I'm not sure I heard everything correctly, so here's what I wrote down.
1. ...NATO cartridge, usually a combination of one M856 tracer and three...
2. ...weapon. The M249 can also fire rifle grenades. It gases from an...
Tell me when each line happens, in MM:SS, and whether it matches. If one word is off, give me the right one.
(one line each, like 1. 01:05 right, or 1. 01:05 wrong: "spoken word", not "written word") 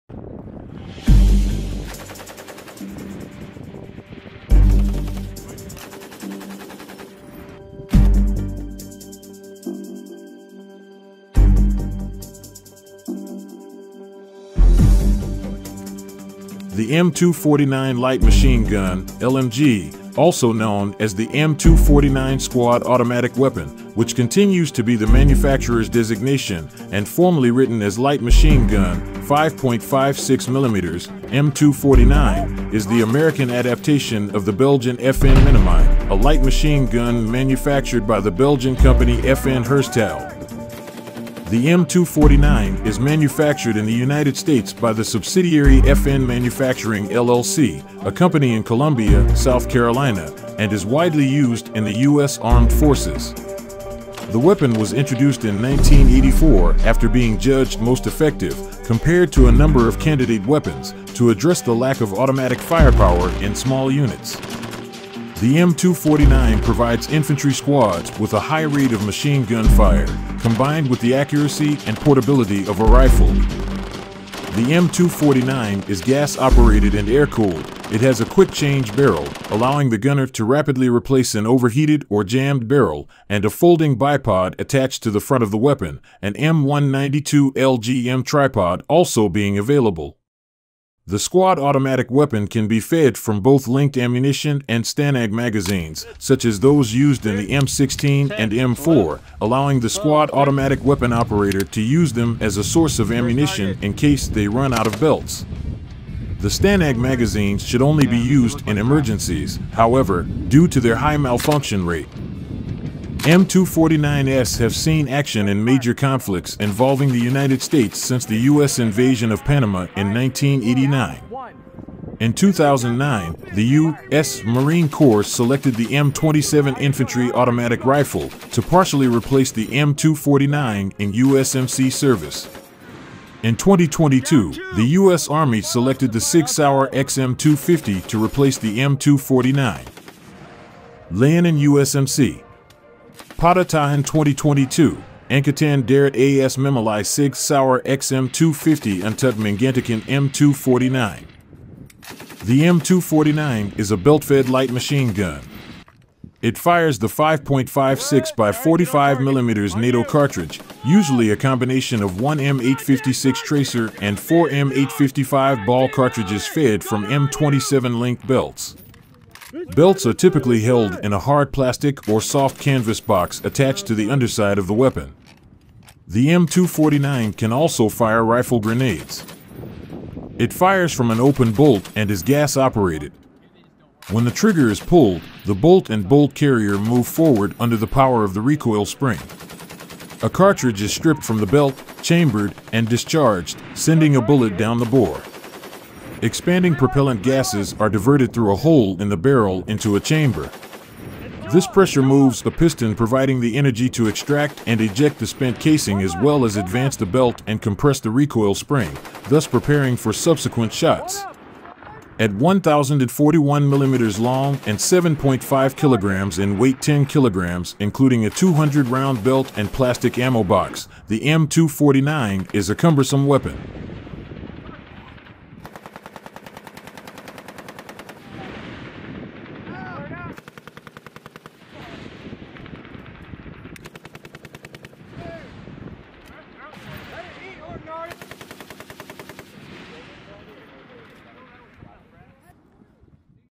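1. 02:39 wrong: "four", not "three"
2. 02:54 wrong: "fires", not "gases".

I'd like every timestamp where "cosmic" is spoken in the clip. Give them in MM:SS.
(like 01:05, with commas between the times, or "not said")
not said.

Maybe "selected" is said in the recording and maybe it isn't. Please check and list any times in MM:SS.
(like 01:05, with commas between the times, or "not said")
02:05, 02:15.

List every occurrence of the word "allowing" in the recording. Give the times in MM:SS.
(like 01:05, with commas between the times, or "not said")
01:19, 01:39.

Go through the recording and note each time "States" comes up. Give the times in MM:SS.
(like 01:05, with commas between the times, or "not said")
00:44, 01:57.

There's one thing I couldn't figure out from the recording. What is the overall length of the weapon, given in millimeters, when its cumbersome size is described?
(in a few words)
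1,041 millimeters.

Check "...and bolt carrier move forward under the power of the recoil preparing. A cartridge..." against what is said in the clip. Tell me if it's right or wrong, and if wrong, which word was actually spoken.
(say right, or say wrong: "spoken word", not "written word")
wrong: "spring", not "preparing".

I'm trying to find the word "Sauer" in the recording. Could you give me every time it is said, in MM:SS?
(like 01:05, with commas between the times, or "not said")
02:16, 02:27.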